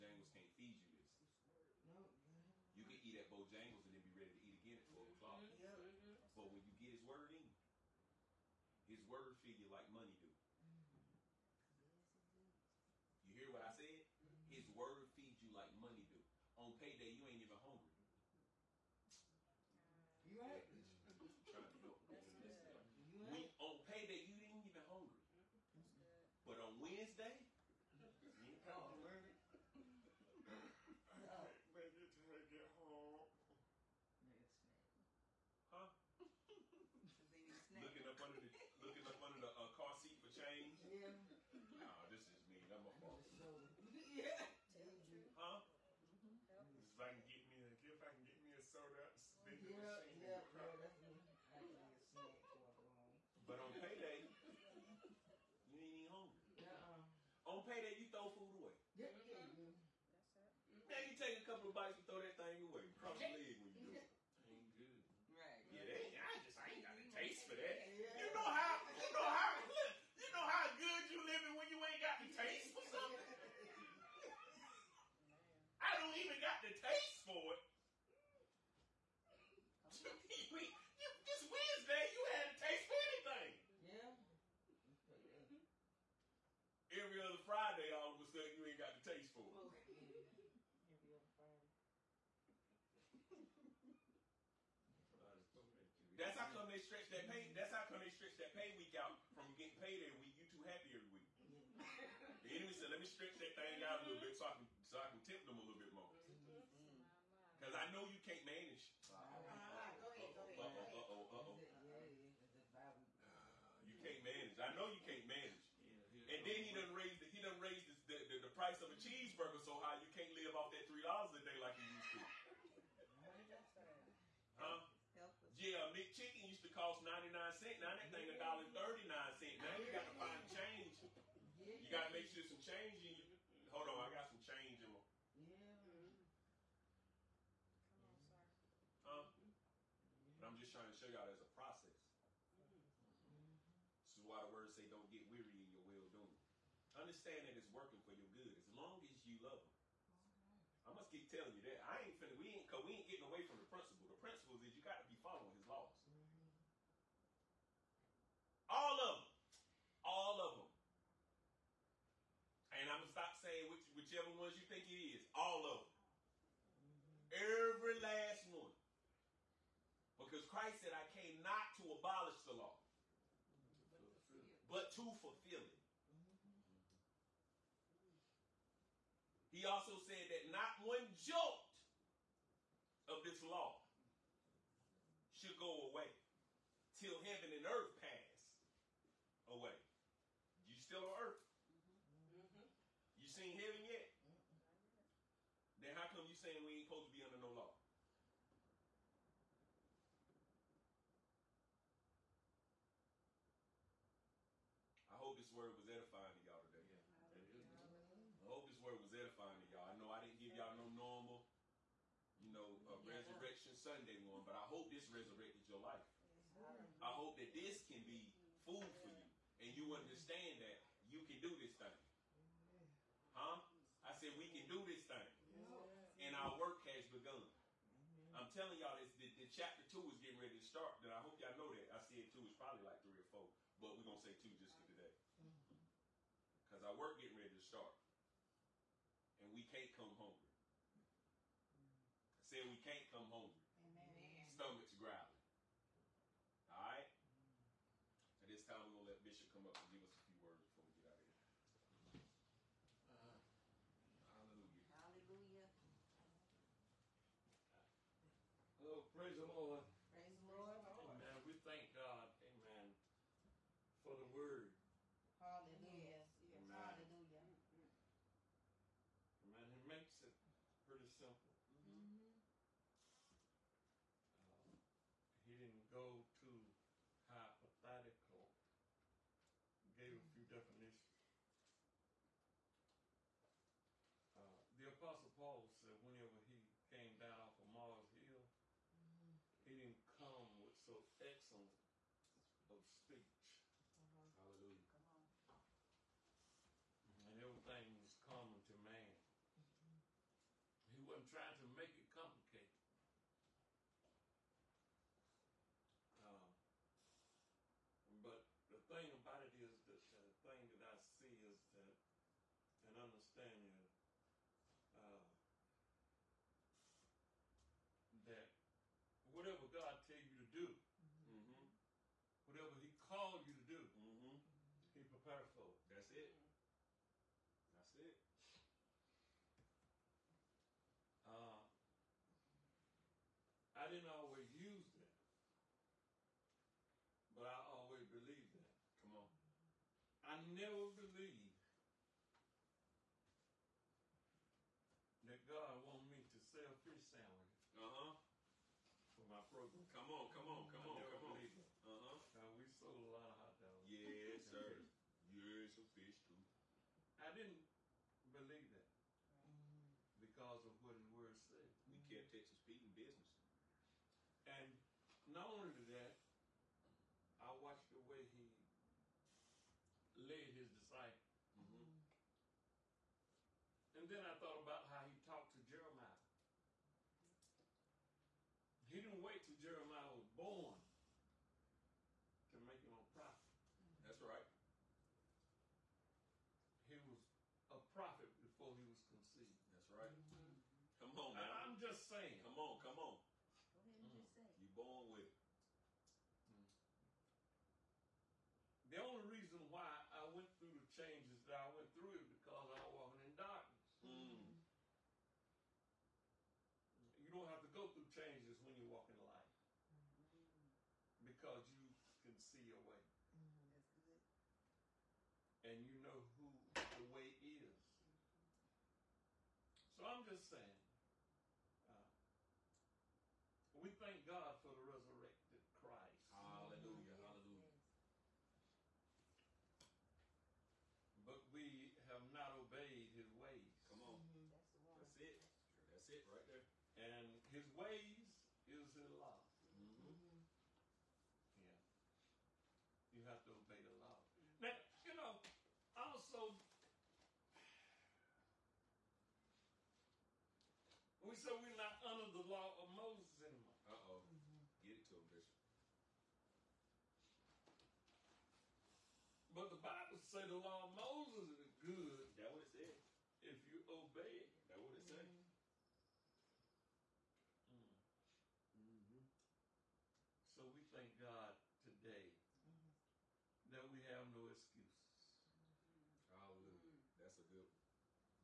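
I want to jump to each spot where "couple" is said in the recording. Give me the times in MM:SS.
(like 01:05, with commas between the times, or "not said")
01:01.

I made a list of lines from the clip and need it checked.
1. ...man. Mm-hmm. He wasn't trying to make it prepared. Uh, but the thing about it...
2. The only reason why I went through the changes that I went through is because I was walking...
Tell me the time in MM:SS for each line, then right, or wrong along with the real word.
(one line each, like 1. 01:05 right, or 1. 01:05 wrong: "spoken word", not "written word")
1. 04:58 wrong: "complicated", not "prepared"
2. 06:38 right.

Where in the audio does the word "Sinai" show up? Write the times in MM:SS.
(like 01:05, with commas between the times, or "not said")
not said.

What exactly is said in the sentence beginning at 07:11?
But we have not obeyed his ways.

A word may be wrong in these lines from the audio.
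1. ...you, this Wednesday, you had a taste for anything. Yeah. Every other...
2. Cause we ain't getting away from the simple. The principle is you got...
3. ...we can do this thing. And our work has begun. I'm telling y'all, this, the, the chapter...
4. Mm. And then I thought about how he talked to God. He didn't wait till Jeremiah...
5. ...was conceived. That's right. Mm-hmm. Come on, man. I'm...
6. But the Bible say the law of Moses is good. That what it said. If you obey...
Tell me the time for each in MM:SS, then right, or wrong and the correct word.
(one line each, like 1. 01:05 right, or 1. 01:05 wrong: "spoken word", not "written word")
1. 01:20 right
2. 02:32 wrong: "principle", not "simple"
3. 03:44 right
4. 06:11 wrong: "Jeremiah", not "God"
5. 06:28 right
6. 07:39 right.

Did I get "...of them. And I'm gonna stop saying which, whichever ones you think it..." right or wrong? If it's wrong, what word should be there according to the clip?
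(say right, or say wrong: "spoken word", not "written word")
right.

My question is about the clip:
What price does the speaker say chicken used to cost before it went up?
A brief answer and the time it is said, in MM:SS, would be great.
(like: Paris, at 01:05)
99 cents, at 02:07.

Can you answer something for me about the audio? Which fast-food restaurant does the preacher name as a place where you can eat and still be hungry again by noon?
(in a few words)
Bojangles.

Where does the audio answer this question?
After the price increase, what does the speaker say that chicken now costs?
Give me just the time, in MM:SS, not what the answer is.
02:08.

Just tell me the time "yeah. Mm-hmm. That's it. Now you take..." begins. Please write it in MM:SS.
00:59.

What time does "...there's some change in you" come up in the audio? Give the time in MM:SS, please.
02:12.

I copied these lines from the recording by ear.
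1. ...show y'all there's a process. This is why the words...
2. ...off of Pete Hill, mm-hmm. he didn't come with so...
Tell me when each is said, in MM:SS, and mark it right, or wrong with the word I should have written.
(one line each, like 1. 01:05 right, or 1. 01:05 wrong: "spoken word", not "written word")
1. 02:20 right
2. 04:47 wrong: "Mars", not "Pete".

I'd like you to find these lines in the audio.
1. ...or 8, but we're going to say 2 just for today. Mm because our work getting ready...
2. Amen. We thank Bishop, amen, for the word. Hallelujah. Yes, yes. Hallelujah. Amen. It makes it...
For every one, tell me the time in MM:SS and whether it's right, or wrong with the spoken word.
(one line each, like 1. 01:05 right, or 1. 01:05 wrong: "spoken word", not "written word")
1. 03:53 wrong: "4", not "8"
2. 04:21 wrong: "God", not "Bishop".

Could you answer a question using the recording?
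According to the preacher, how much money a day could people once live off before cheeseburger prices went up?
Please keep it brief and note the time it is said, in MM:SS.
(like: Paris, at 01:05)
3 dollars, at 02:00.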